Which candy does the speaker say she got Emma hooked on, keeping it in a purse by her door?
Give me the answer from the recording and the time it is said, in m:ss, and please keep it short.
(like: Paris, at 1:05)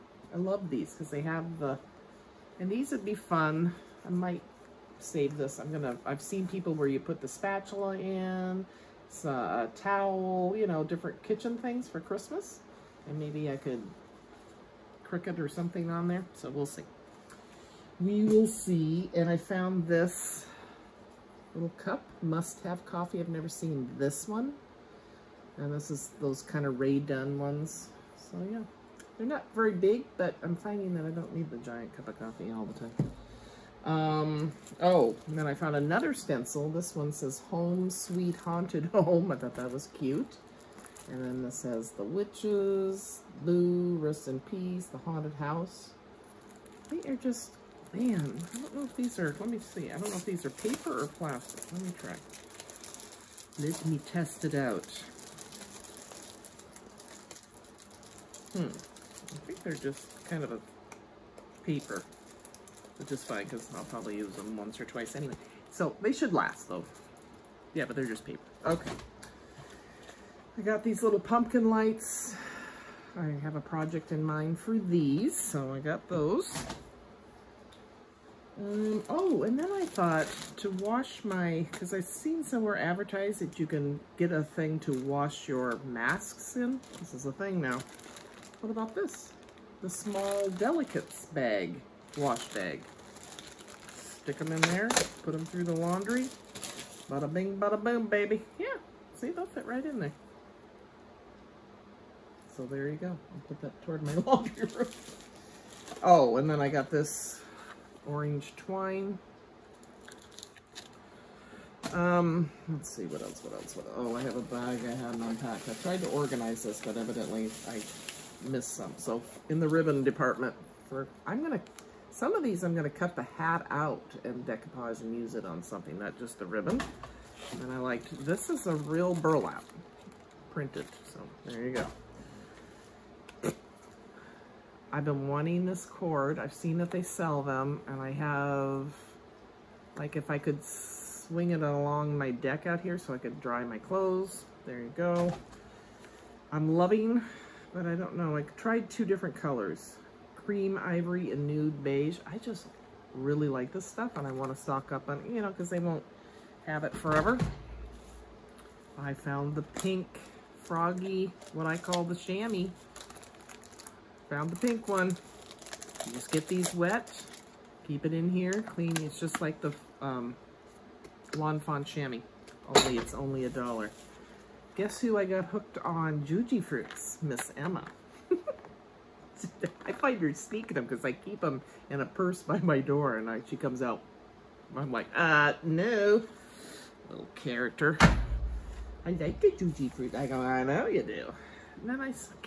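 Jujyfruits, at 2:56.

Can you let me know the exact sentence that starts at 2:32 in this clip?
I just really like this stuff and I want to stock up on, you know, because they won't have it forever.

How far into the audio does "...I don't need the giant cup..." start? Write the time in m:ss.
0:31.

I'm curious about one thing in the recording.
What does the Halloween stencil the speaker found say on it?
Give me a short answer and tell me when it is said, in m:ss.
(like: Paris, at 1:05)
Home Sweet Haunted Home, at 0:37.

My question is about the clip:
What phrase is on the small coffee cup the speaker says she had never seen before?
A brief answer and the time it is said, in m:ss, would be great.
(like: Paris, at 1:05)
Must have coffee, at 0:22.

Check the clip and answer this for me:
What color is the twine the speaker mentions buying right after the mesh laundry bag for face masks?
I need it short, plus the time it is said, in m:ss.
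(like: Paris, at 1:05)
Orange, at 1:48.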